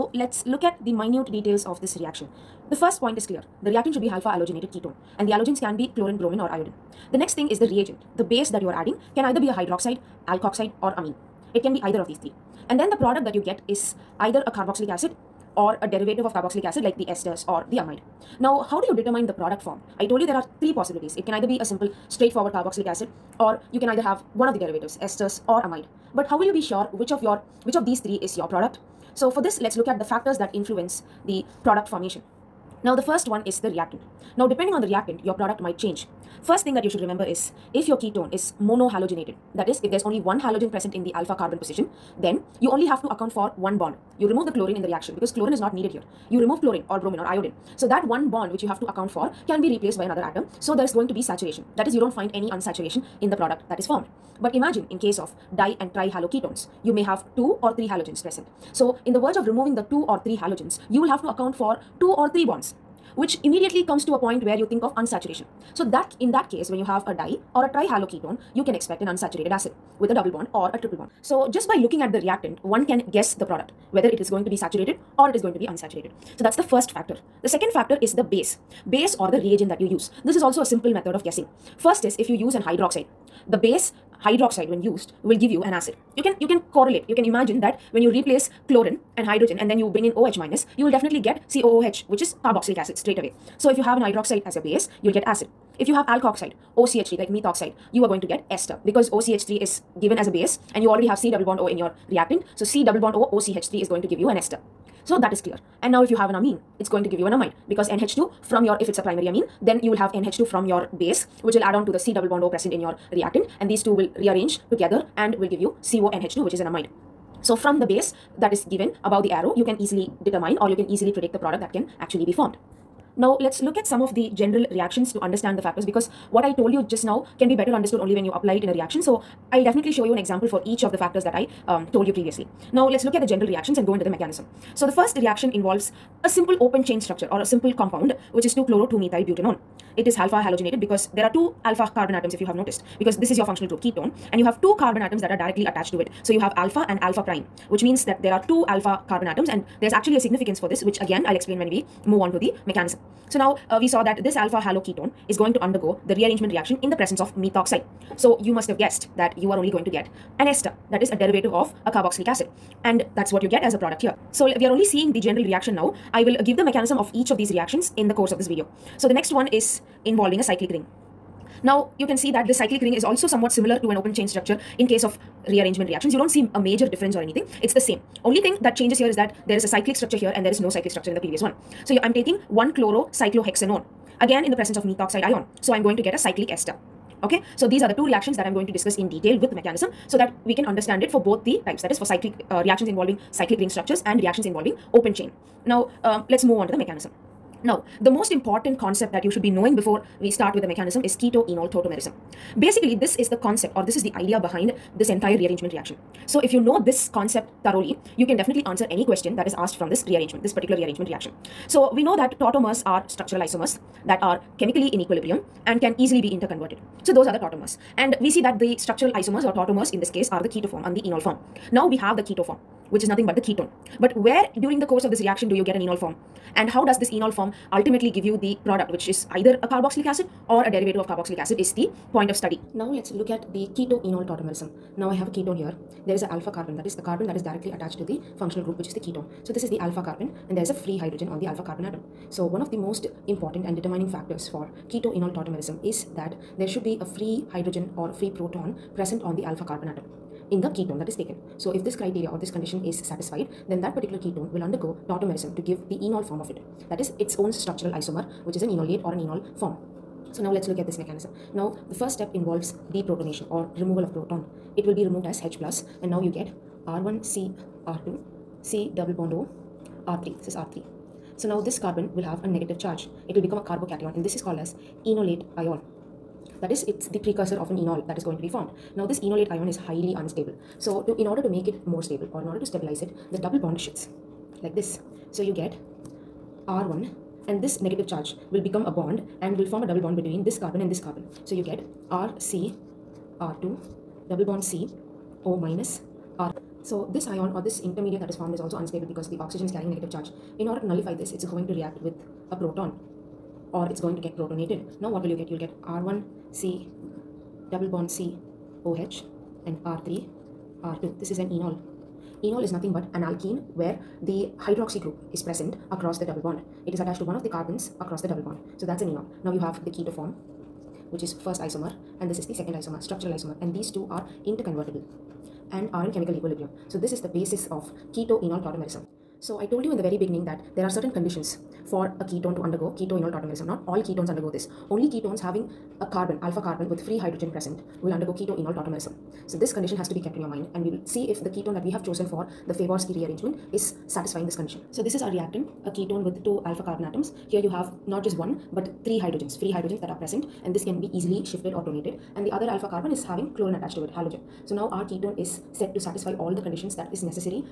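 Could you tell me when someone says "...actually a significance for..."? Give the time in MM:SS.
02:29.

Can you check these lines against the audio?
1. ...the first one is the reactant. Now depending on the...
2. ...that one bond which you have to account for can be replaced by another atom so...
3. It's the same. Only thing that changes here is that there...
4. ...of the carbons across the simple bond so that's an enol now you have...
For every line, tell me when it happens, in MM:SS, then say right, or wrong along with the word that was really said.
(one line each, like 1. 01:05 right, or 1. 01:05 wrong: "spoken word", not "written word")
1. 00:32 right
2. 00:47 right
3. 02:57 right
4. 05:17 wrong: "double", not "simple".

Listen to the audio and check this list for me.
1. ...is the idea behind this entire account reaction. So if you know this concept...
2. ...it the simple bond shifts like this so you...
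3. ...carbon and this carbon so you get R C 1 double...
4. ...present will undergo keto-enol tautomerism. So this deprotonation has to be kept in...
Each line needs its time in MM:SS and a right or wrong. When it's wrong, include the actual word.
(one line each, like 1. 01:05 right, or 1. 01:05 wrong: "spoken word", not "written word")
1. 03:23 wrong: "rearrangement", not "account"
2. 04:43 wrong: "double", not "simple"
3. 04:50 wrong: "2", not "1"
4. 05:37 wrong: "condition", not "deprotonation".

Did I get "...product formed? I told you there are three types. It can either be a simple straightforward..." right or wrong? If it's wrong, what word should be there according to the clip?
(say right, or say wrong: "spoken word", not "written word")
wrong: "possibilities", not "types".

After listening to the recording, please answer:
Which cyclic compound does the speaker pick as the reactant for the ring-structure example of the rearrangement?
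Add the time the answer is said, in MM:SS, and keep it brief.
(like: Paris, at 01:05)
1-chlorocyclohexanone, at 03:02.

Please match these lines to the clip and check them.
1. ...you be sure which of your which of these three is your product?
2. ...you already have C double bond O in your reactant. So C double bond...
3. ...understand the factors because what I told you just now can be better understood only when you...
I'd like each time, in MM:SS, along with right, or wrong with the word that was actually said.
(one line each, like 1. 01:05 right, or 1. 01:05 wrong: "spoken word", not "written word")
1. 00:26 right
2. 01:40 right
3. 02:05 right.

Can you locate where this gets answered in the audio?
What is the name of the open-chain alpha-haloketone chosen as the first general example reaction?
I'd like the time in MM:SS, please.
02:18.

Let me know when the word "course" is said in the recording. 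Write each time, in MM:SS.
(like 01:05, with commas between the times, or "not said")
02:48, 03:44.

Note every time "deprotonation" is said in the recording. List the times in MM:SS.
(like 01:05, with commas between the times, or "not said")
04:22.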